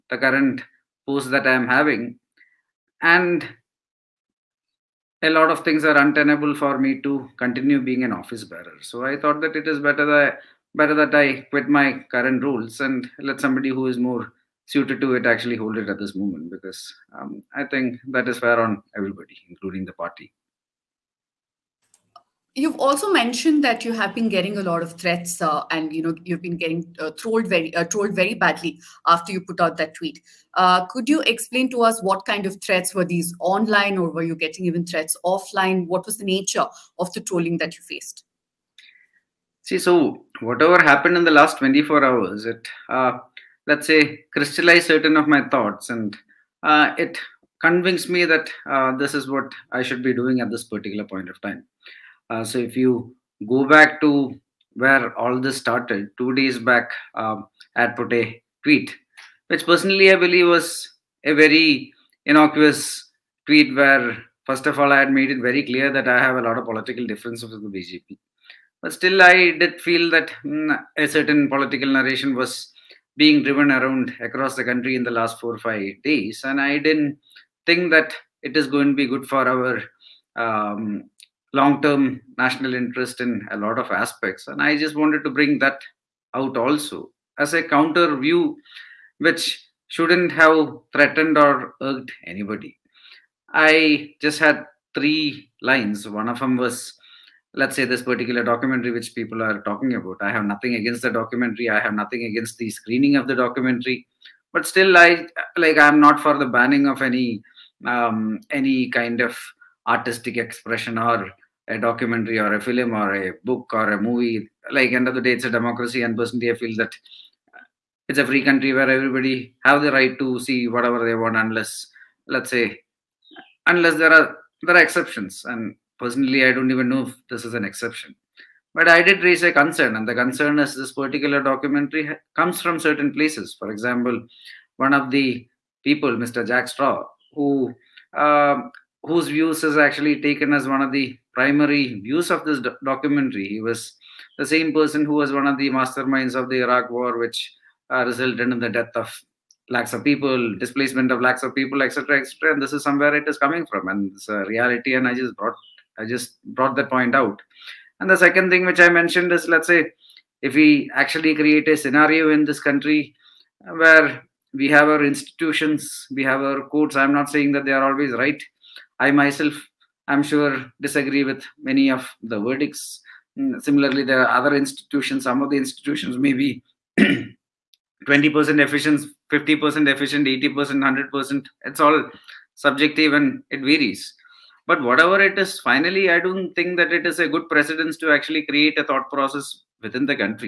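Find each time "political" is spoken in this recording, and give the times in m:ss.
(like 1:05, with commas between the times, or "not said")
1:06, 1:11.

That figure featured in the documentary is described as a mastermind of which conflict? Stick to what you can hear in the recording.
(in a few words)
Iraq War.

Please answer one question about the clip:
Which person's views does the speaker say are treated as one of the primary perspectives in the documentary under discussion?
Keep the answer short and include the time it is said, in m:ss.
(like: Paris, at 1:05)
Jack Straw, at 2:16.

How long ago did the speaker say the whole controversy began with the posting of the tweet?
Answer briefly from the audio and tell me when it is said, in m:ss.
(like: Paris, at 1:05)
2 days, at 0:56.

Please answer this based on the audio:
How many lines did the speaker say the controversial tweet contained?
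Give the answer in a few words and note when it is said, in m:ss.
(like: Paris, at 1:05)
3, at 1:34.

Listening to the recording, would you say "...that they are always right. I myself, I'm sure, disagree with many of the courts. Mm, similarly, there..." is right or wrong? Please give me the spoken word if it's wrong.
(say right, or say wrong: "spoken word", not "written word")
wrong: "verdicts", not "courts".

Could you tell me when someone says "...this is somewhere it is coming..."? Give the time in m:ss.
2:32.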